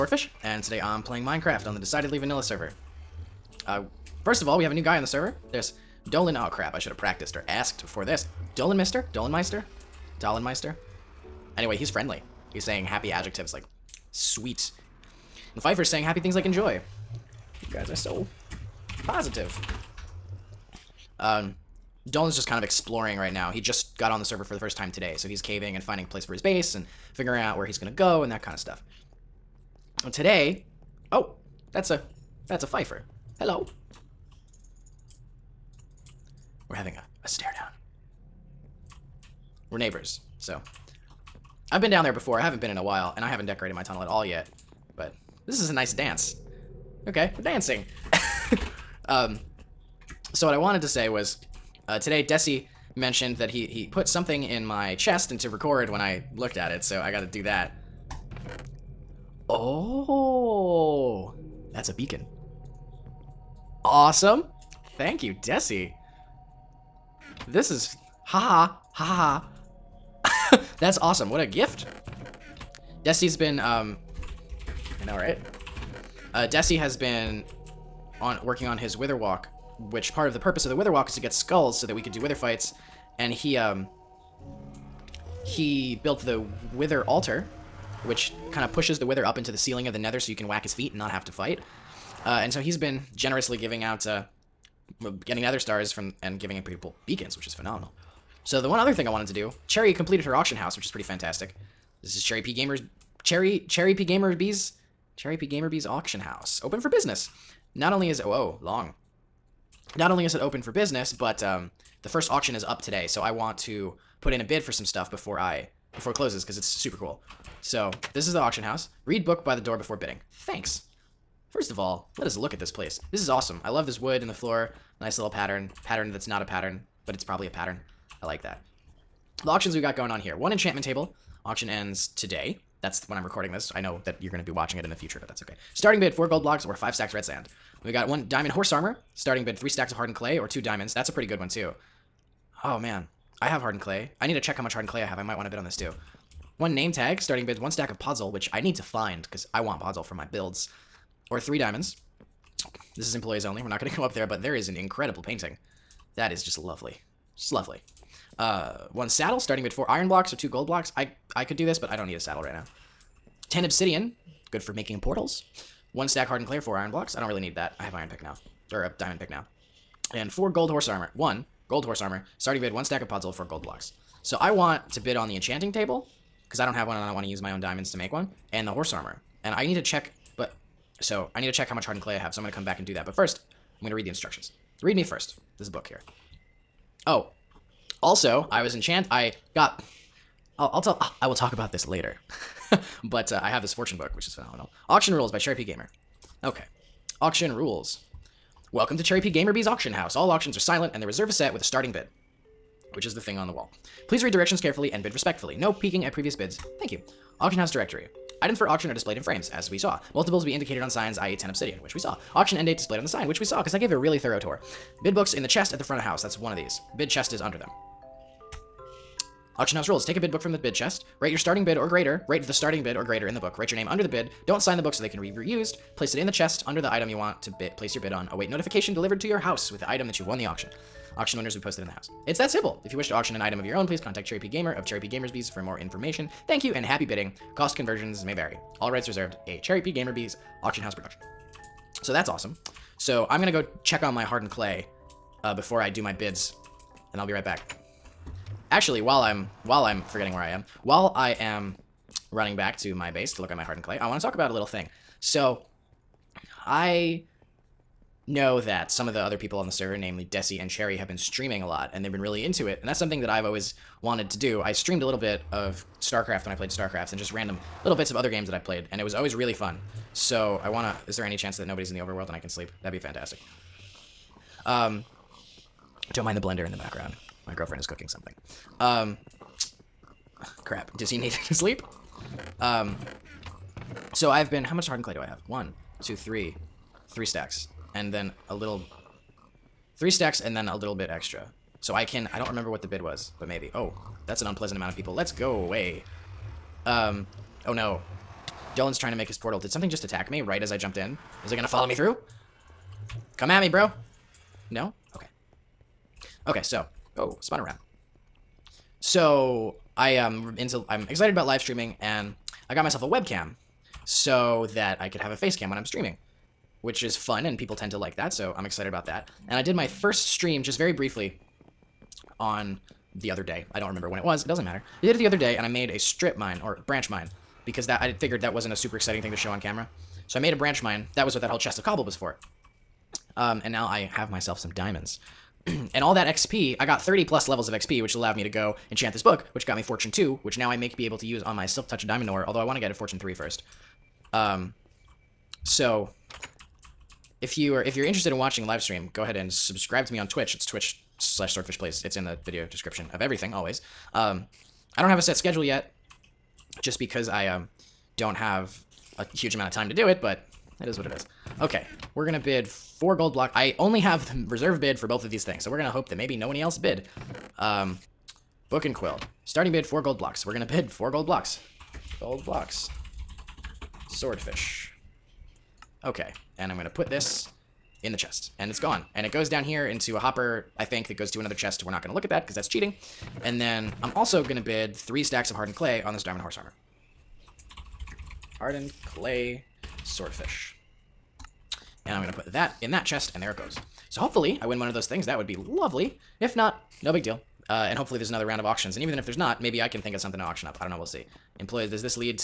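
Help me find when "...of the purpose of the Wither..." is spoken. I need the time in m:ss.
1:20.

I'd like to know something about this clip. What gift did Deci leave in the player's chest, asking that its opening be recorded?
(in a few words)
A beacon.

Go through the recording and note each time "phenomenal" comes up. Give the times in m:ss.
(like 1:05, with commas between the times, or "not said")
1:37, 3:14.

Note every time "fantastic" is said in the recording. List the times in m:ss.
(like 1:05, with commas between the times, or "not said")
1:41, 4:32.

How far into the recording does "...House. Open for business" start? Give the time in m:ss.
1:46.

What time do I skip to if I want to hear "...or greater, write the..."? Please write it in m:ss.
3:41.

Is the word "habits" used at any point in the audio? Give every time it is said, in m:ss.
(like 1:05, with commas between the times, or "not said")
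not said.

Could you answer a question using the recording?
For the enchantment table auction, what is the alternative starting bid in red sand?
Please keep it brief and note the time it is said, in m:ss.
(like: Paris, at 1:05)
5 stacks red sand, at 2:16.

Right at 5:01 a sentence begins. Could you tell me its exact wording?
Is it gonna follow me through?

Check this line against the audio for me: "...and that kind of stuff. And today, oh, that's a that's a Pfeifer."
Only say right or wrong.
right.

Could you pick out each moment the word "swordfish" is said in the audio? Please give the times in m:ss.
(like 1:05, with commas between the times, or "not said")
5:51, 6:14, 6:30.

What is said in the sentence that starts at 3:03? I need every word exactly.
But first, I'm going to read the instructions.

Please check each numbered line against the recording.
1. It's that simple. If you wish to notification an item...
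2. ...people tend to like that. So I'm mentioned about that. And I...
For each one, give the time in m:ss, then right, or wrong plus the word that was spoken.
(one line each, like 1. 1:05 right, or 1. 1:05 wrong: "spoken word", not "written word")
1. 3:52 wrong: "auction", not "notification"
2. 5:17 wrong: "excited", not "mentioned".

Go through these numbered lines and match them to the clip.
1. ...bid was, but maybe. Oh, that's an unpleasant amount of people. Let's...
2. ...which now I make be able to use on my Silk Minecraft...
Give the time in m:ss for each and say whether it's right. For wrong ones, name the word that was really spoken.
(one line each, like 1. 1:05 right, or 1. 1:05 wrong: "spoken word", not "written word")
1. 4:52 right
2. 5:40 wrong: "Touch", not "Minecraft".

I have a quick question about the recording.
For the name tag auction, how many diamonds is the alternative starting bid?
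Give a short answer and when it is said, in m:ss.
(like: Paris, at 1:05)
3, at 2:31.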